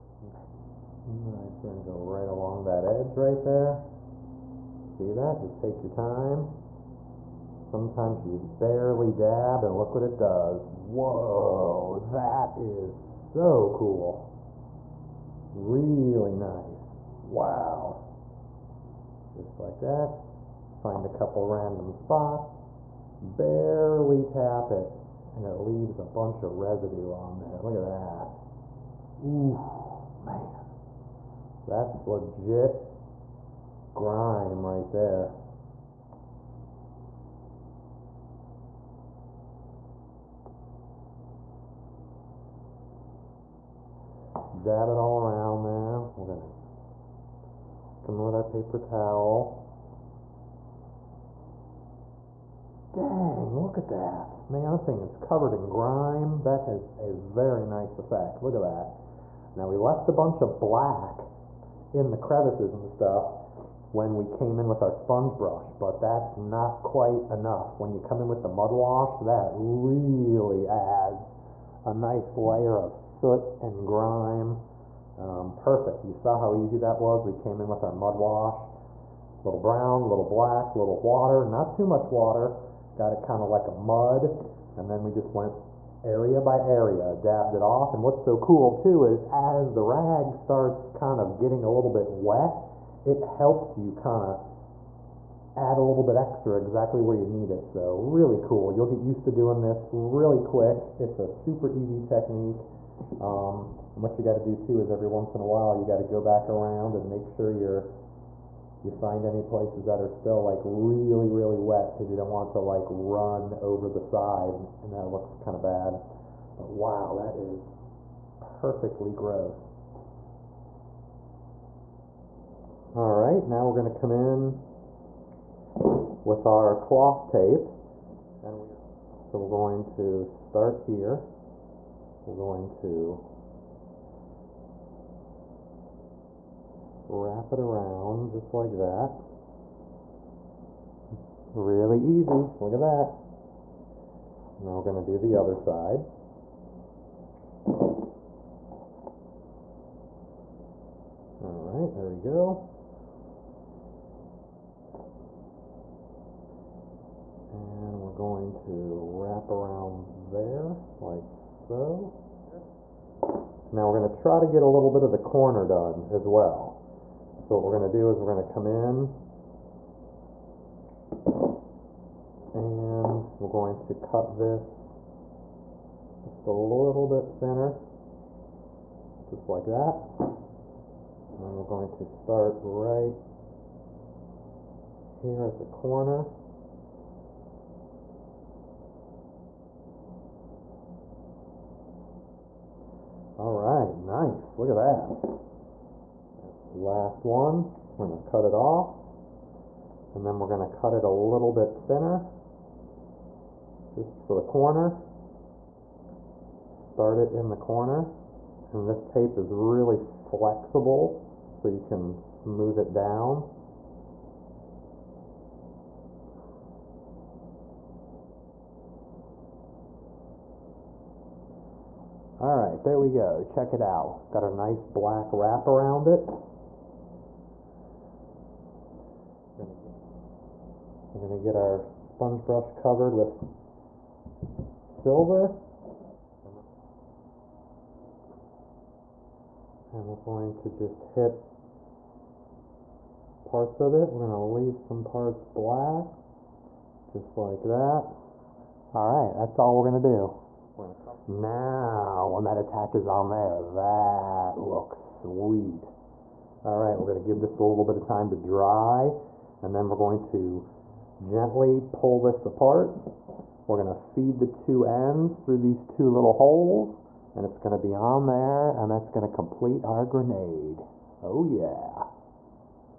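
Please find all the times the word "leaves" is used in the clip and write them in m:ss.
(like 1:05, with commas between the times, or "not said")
0:25, 4:04.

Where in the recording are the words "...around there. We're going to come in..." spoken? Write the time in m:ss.
0:45.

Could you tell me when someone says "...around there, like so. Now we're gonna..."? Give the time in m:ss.
2:39.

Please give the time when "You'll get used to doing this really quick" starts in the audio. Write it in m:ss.
1:38.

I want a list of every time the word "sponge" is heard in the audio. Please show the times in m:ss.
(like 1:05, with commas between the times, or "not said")
1:04, 3:51.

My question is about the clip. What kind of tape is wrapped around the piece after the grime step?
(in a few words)
cloth tape.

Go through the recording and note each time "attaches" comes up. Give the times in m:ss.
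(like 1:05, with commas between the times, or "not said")
4:12.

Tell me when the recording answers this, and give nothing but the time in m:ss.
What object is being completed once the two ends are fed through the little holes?
4:30.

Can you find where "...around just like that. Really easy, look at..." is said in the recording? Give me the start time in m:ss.
2:17.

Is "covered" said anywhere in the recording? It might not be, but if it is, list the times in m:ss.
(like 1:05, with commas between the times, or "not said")
0:55, 3:52.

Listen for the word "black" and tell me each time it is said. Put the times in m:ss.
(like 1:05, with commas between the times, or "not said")
1:00, 1:20, 3:44, 4:05.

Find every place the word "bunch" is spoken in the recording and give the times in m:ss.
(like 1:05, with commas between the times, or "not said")
0:26, 1:00.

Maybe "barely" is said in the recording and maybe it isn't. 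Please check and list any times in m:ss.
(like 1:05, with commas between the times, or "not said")
0:08, 0:23.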